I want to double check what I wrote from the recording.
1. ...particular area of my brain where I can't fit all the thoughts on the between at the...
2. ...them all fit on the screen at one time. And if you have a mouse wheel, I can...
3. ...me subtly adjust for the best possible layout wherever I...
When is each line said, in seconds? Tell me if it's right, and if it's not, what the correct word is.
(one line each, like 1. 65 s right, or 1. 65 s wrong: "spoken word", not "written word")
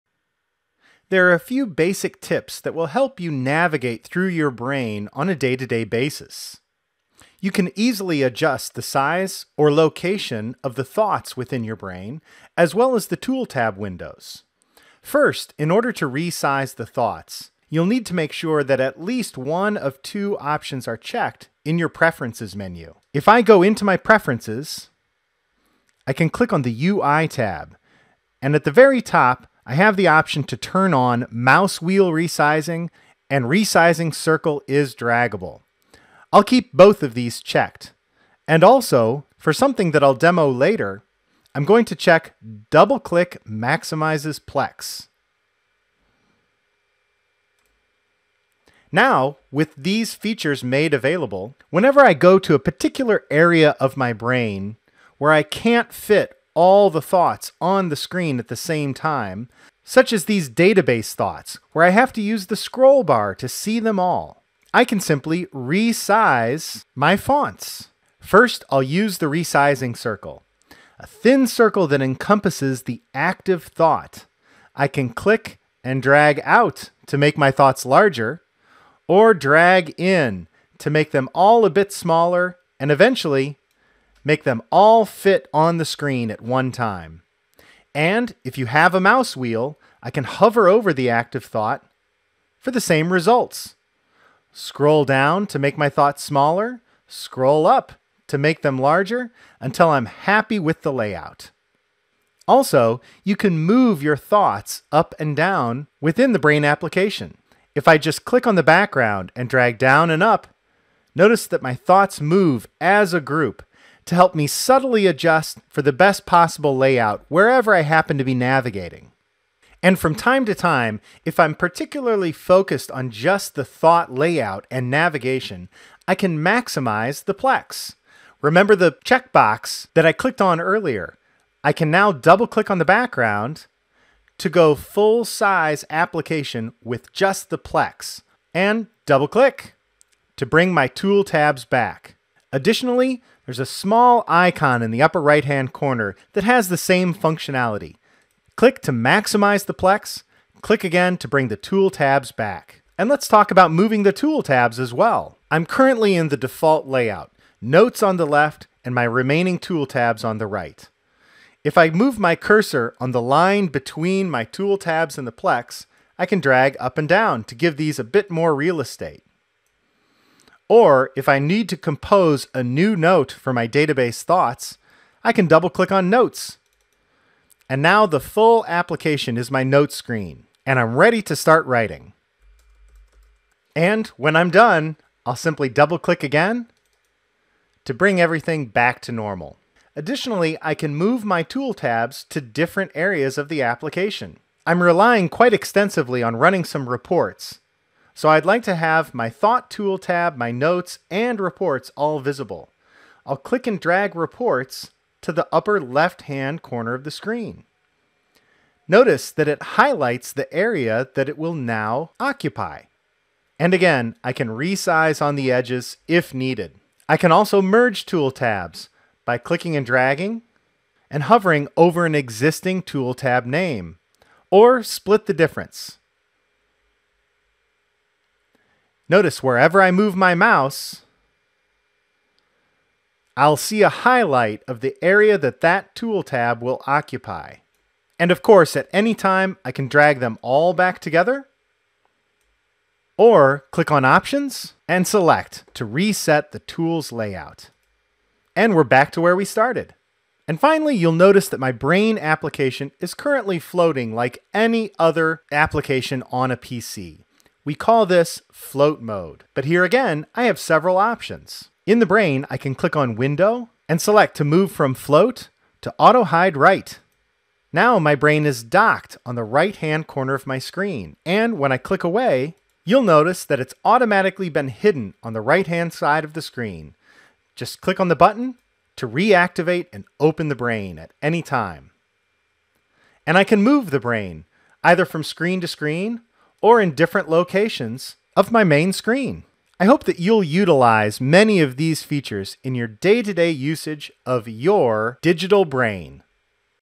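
1. 52 s wrong: "screen", not "between"
2. 84 s right
3. 114 s right.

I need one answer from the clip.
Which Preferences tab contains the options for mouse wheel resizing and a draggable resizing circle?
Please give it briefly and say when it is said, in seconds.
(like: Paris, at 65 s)
UI, at 26 s.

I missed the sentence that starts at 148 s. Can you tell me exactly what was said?
Click to maximize the Plex, click again to bring the tool tabs back.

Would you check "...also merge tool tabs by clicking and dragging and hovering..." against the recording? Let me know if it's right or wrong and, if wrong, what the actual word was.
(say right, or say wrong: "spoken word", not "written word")
right.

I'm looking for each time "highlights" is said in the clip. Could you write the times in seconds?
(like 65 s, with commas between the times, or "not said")
209 s, 233 s.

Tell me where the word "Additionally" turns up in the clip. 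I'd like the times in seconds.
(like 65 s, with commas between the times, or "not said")
142 s, 189 s.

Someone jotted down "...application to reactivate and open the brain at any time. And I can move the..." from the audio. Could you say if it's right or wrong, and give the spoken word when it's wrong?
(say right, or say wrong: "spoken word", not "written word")
wrong: "button", not "application".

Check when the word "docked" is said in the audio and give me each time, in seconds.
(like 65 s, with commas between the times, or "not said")
268 s.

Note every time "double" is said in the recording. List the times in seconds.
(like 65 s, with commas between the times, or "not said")
42 s, 132 s, 139 s, 175 s, 185 s.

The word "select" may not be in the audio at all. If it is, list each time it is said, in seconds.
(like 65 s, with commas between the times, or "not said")
245 s, 264 s.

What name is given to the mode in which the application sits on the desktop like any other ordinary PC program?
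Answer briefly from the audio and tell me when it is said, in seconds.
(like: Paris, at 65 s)
float mode, at 258 s.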